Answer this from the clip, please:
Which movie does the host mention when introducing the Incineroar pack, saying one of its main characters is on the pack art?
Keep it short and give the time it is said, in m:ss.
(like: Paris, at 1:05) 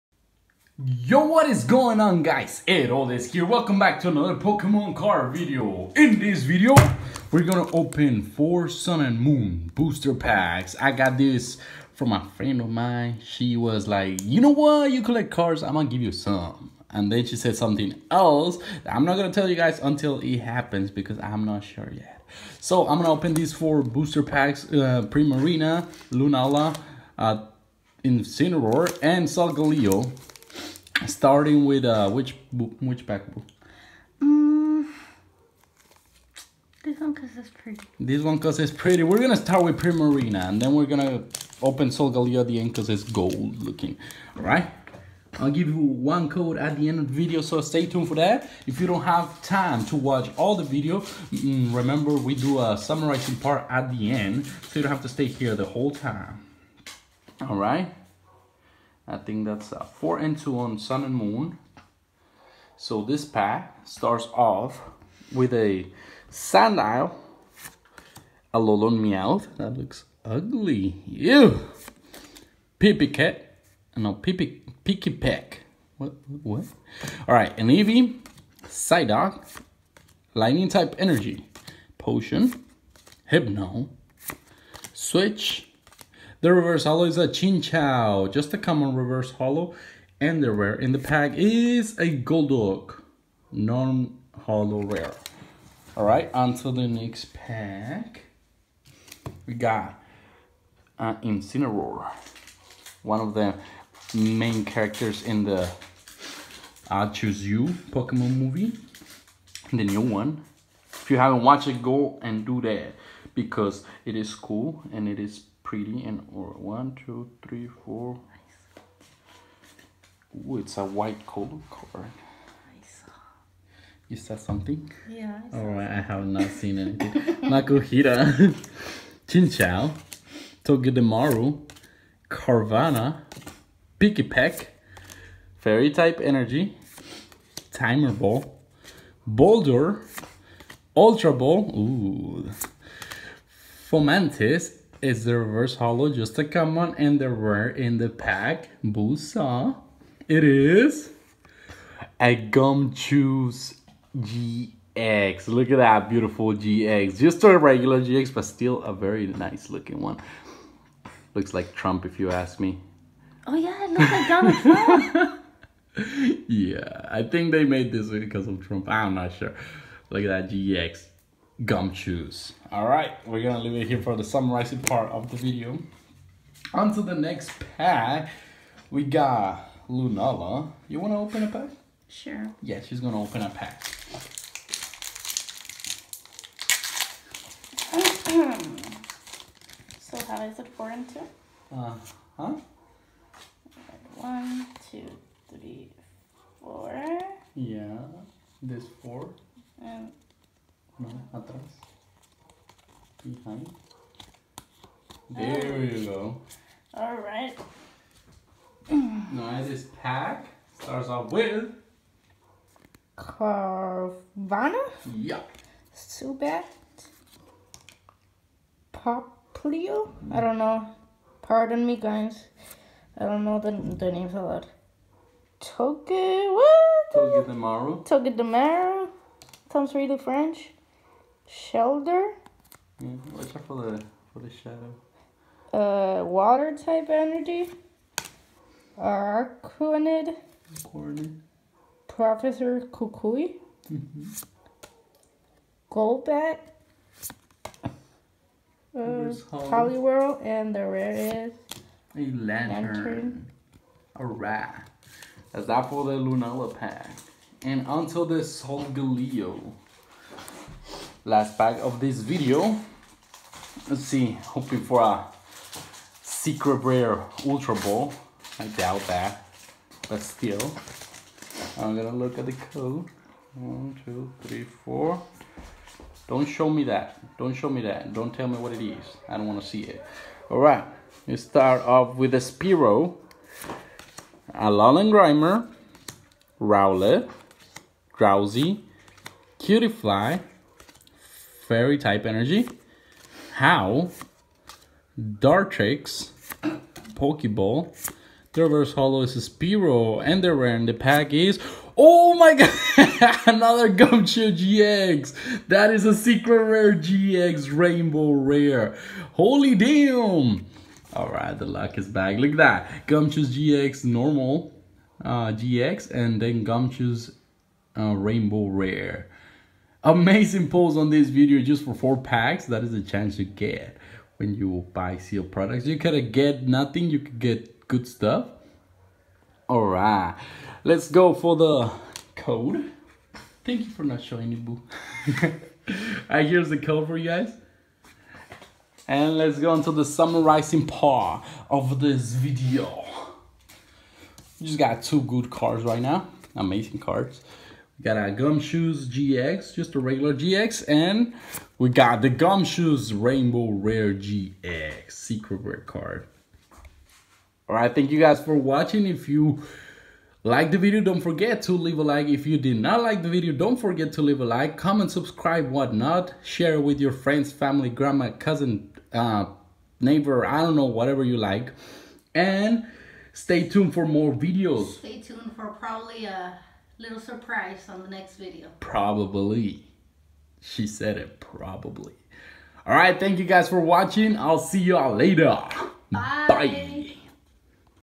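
I Choose You, at 1:46.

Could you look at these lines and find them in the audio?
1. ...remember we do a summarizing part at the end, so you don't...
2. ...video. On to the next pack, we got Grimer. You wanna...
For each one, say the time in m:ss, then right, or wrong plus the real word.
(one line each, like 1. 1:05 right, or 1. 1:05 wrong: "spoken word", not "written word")
1. 0:51 right
2. 2:55 wrong: "Lunala", not "Grimer".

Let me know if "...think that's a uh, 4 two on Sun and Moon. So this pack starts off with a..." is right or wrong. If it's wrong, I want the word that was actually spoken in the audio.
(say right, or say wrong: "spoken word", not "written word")
right.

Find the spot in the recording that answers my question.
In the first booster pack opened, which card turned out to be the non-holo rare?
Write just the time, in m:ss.
1:32.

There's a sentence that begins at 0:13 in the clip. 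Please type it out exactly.
She was like, you know what?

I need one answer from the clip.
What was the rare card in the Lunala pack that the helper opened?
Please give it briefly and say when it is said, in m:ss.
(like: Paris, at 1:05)
Lanturn, at 4:12.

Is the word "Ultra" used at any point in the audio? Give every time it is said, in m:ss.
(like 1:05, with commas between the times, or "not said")
2:20, 4:27.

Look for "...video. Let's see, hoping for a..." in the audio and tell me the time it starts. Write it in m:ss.
4:22.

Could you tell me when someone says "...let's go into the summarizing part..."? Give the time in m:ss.
5:39.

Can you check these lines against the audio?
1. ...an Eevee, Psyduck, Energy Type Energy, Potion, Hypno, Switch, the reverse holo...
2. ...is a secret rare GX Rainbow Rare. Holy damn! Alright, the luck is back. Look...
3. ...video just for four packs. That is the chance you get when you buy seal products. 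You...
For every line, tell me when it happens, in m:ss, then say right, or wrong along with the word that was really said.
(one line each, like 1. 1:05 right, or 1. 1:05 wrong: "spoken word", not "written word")
1. 1:17 wrong: "Lightning", not "Energy"
2. 5:05 right
3. 5:21 right.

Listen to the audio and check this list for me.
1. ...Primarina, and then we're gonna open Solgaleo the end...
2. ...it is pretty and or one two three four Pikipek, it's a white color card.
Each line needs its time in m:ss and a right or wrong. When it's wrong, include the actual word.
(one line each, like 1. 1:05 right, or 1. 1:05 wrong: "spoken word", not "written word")
1. 0:39 right
2. 1:55 wrong: "Ooh", not "Pikipek".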